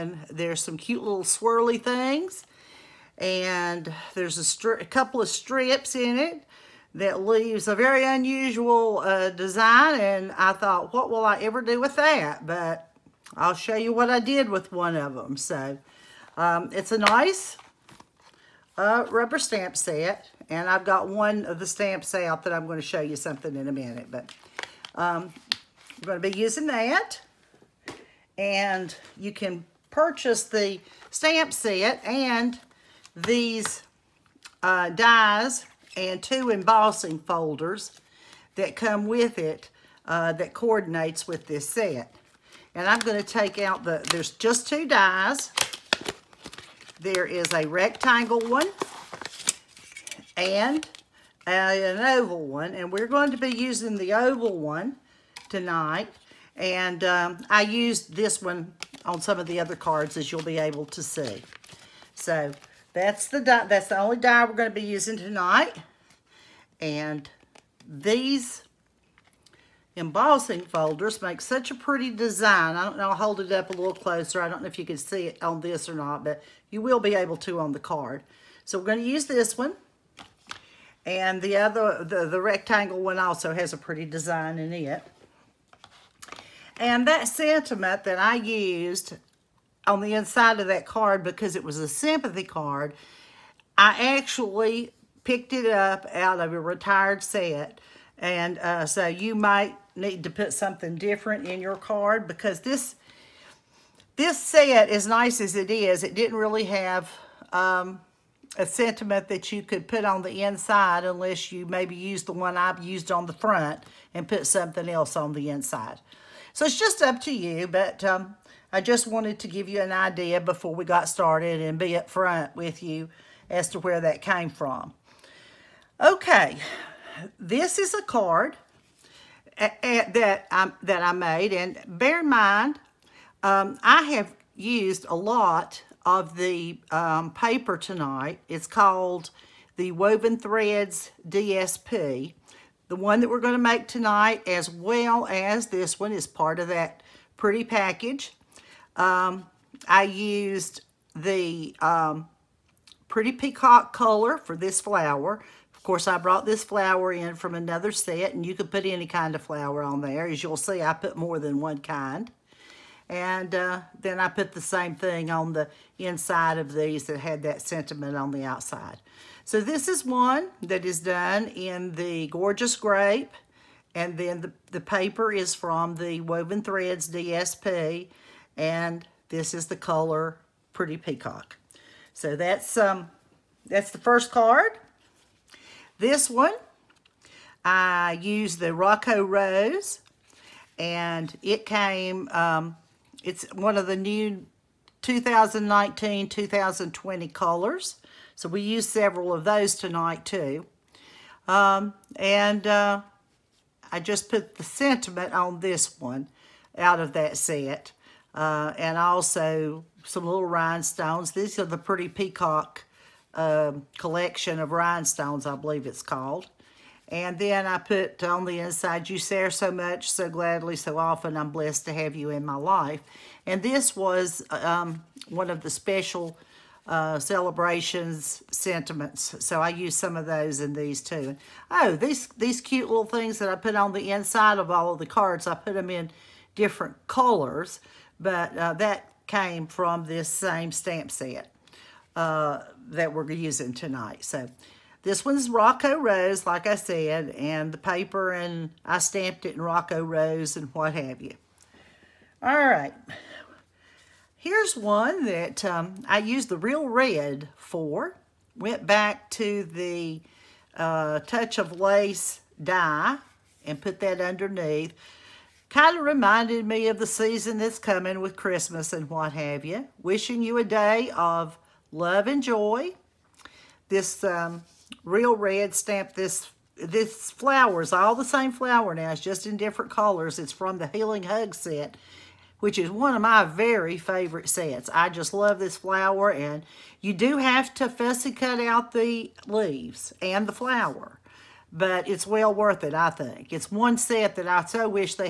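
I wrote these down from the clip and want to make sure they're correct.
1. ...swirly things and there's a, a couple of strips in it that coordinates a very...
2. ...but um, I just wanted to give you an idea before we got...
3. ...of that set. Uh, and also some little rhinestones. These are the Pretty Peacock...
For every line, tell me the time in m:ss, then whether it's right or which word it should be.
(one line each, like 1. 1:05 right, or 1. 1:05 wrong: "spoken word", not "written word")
1. 0:01 wrong: "leaves", not "coordinates"
2. 1:57 right
3. 3:26 right.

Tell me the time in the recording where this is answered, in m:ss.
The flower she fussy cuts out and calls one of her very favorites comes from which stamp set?
4:40.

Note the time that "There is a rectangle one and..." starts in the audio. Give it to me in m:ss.
0:46.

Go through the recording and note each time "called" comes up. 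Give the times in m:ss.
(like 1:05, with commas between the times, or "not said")
2:18, 3:36.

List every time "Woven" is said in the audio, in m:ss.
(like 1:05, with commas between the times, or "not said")
2:19, 2:56.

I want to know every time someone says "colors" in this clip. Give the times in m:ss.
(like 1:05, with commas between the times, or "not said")
2:33, 2:59, 3:17, 3:57, 4:39.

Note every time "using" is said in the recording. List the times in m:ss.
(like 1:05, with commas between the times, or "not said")
0:26, 0:53, 1:04, 4:03.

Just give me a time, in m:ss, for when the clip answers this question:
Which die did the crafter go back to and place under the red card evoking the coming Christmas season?
4:21.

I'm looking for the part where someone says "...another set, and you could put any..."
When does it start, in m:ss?
2:37.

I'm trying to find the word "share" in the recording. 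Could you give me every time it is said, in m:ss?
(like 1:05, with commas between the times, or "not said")
3:39.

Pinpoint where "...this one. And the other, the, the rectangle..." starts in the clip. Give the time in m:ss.
1:19.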